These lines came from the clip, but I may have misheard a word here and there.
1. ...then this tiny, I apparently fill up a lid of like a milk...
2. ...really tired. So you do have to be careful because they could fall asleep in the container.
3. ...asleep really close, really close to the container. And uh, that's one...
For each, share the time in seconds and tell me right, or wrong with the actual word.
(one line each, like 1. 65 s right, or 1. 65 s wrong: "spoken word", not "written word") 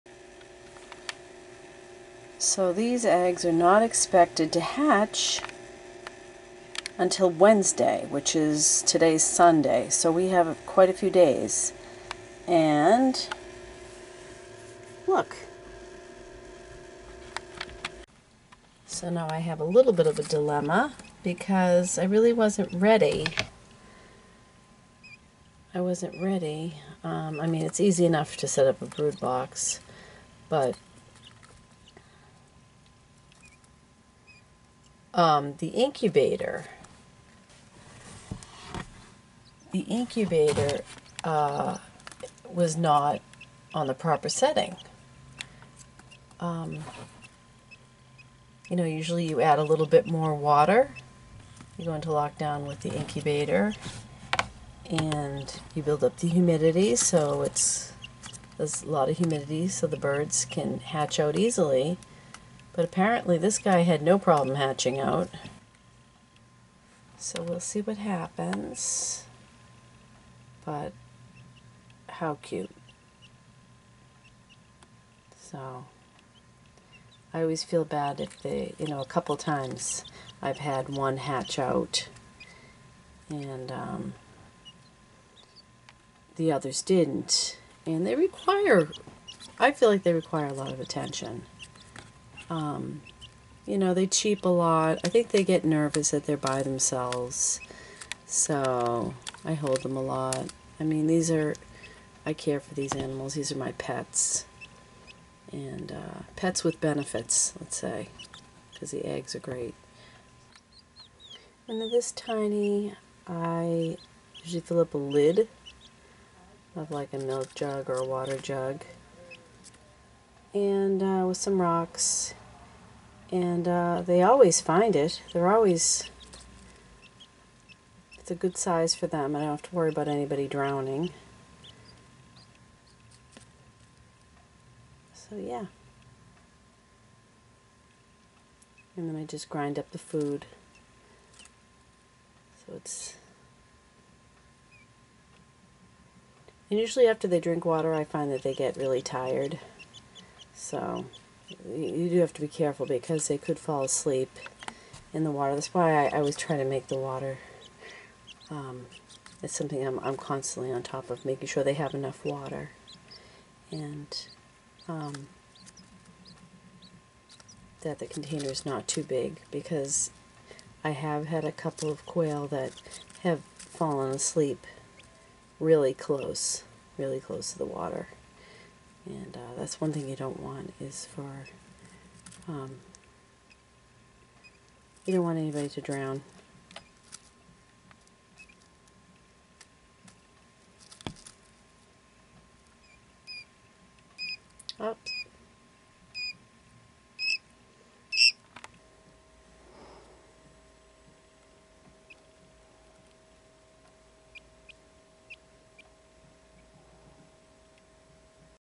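1. 111 s wrong: "usually", not "apparently"
2. 148 s wrong: "water", not "container"
3. 174 s wrong: "water", not "container".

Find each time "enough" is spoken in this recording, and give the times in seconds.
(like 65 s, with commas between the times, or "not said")
28 s, 161 s.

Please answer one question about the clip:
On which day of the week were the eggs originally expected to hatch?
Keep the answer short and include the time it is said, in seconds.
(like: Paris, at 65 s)
Wednesday, at 7 s.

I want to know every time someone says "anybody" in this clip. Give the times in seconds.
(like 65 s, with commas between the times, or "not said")
130 s, 185 s.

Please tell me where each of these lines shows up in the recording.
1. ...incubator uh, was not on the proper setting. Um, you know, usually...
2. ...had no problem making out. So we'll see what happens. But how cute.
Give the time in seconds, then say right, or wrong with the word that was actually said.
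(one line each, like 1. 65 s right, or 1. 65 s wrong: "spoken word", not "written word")
1. 39 s right
2. 63 s wrong: "hatching", not "making".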